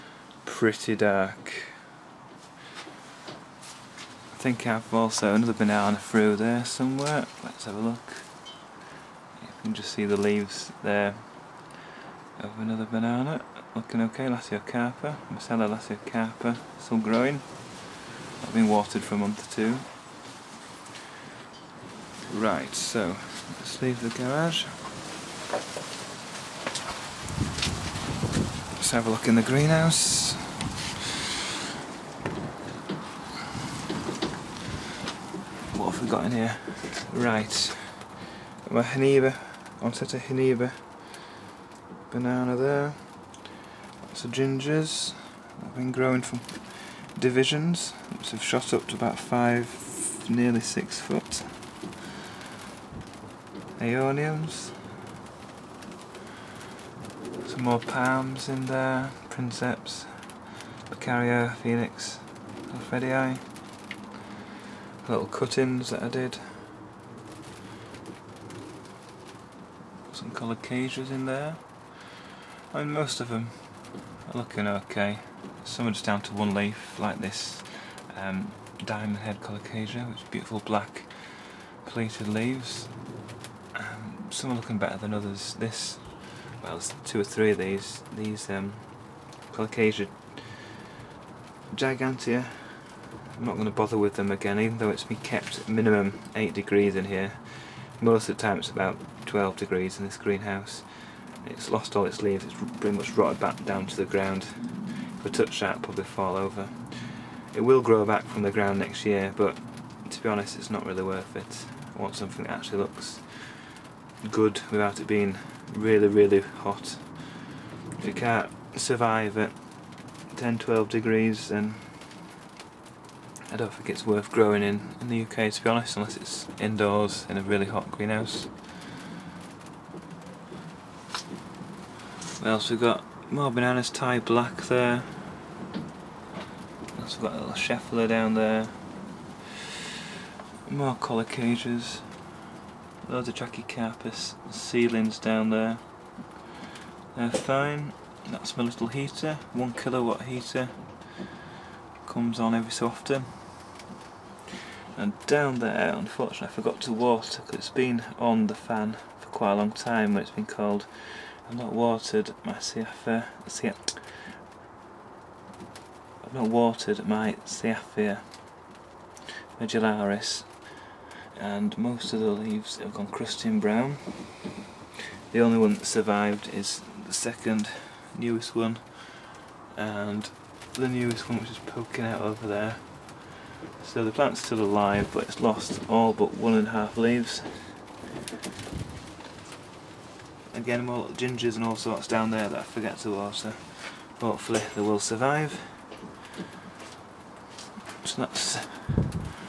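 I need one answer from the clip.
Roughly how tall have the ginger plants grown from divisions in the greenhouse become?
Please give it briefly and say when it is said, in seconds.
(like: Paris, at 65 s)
nearly 6 foot, at 50 s.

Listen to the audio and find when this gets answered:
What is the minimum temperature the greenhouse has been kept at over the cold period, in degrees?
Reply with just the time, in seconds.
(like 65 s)
96 s.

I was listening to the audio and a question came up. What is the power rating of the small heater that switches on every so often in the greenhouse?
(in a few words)
1 kilowatt.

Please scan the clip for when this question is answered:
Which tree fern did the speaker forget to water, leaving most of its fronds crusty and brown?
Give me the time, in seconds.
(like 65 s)
167 s.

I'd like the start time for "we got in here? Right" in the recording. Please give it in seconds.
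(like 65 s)
36 s.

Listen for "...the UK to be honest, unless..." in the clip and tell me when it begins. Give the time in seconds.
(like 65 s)
125 s.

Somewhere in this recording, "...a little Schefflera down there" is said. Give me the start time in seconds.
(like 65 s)
137 s.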